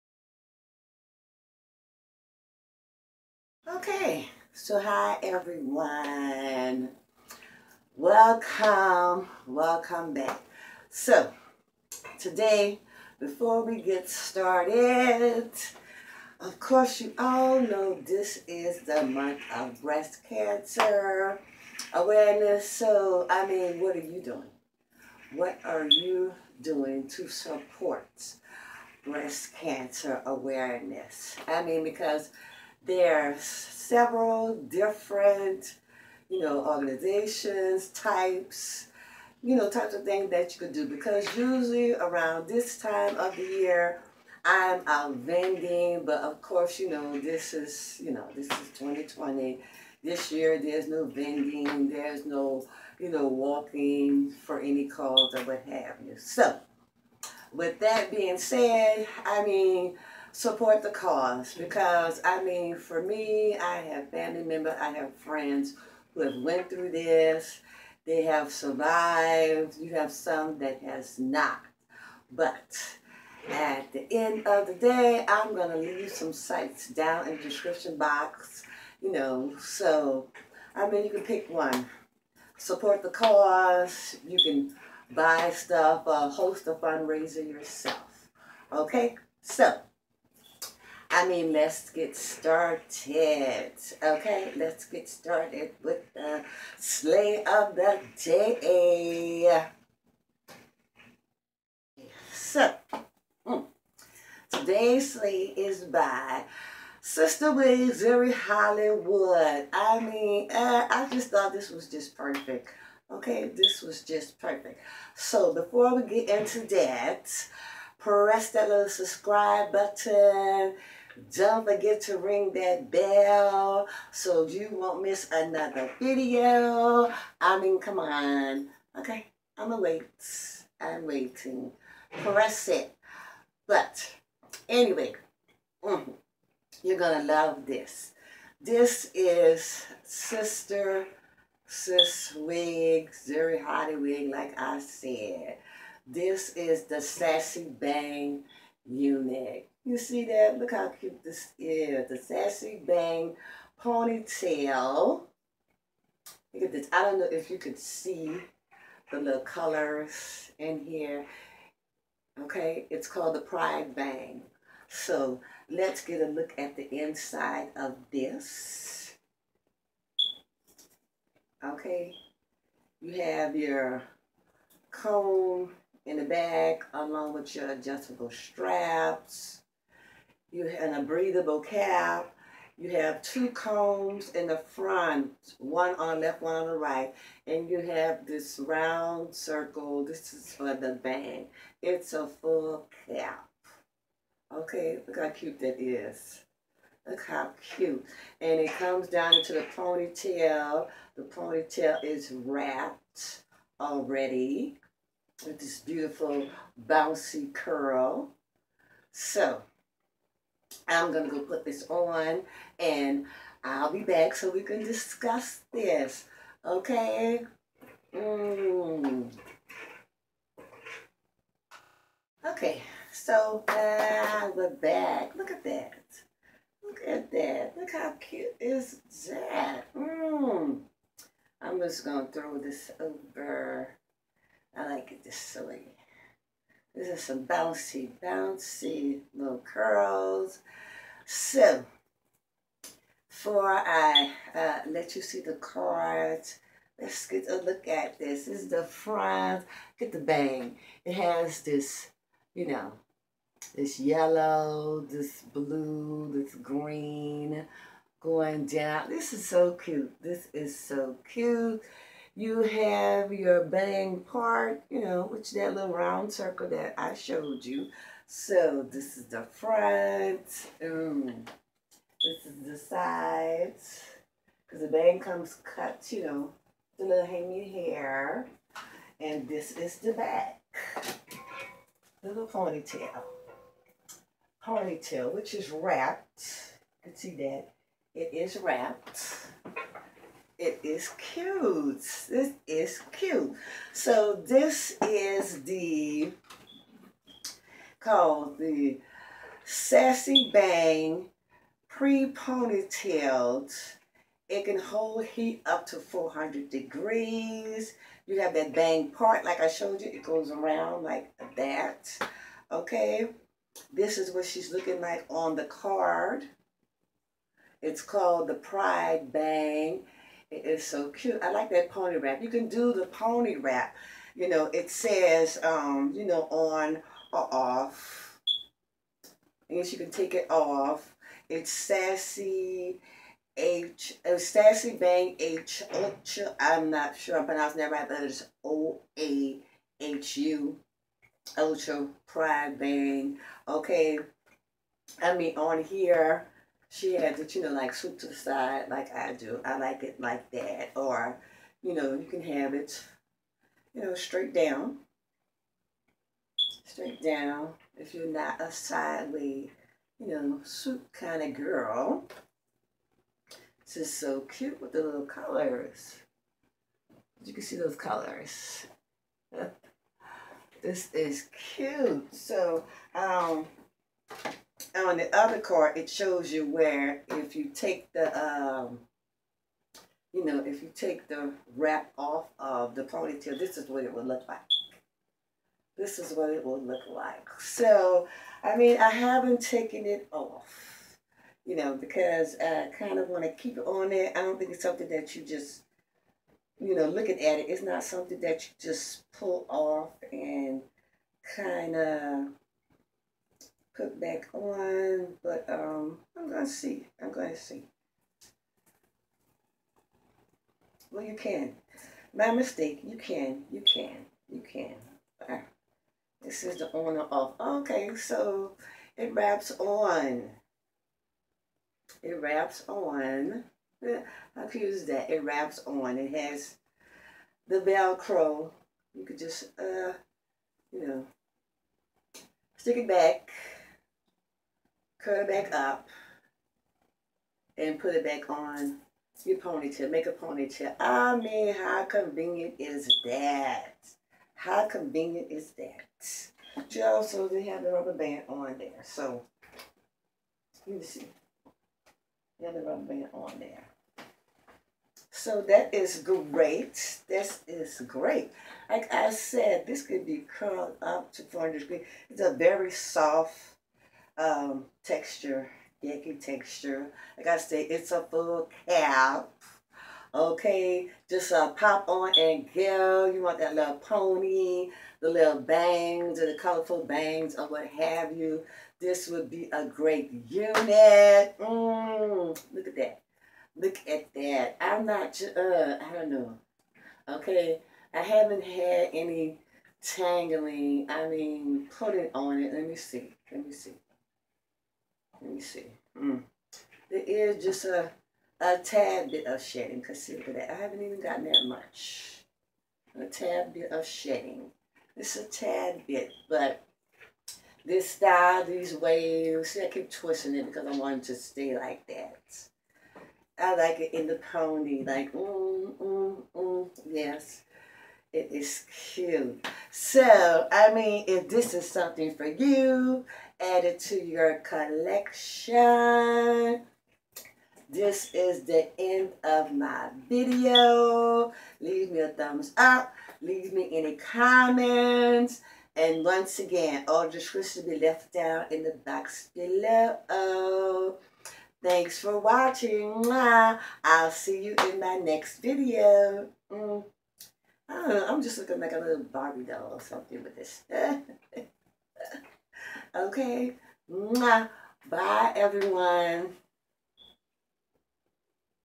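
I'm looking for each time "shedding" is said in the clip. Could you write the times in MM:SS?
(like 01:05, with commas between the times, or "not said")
08:19, 08:24.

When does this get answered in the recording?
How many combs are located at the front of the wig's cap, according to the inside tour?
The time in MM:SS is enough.
03:03.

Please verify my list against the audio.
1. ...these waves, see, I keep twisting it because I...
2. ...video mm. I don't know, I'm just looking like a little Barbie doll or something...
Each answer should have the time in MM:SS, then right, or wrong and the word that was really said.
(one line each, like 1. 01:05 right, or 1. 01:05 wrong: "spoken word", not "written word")
1. 08:28 right
2. 09:05 right.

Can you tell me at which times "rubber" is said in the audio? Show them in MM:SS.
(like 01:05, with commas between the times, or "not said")
07:27, 07:32.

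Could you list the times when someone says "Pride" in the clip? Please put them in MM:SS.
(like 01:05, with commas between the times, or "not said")
02:43, 05:18, 05:42.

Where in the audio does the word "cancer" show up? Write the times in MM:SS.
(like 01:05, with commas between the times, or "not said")
00:20, 00:29.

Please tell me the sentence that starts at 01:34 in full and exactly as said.
Okay, let's get started with the slay of the day.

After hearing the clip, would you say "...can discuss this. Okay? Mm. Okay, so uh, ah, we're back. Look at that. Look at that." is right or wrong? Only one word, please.
right.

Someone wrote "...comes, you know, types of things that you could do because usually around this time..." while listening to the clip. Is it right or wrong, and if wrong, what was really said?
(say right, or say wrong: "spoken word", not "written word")
wrong: "types", not "comes".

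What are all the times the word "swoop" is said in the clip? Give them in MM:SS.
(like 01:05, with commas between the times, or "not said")
05:47, 06:00.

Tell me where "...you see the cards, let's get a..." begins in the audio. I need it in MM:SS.
04:05.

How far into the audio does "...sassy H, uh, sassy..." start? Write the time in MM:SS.
05:31.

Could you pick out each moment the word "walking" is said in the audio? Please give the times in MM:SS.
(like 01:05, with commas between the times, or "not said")
00:53.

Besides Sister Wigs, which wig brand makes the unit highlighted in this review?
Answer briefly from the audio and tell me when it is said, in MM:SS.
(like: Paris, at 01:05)
Zury Hollywood, at 01:48.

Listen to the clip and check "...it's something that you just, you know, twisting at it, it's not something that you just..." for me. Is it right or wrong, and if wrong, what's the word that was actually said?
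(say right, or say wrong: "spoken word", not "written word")
wrong: "looking", not "twisting".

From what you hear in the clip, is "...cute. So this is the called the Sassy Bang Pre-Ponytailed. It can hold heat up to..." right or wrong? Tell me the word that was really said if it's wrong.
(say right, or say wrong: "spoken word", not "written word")
right.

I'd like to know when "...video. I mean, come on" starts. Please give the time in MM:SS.
02:05.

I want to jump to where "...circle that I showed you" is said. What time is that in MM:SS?
04:26.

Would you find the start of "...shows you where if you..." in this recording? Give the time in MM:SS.
06:16.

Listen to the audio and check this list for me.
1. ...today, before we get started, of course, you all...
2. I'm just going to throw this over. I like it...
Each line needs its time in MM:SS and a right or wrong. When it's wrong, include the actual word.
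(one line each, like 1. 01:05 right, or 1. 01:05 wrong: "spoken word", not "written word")
1. 00:12 right
2. 03:51 right.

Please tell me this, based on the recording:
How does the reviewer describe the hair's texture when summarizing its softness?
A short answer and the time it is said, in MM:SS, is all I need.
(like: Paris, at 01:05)
yaki texture, at 07:46.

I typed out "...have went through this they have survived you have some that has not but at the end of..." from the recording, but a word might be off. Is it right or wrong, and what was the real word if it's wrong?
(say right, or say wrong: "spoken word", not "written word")
right.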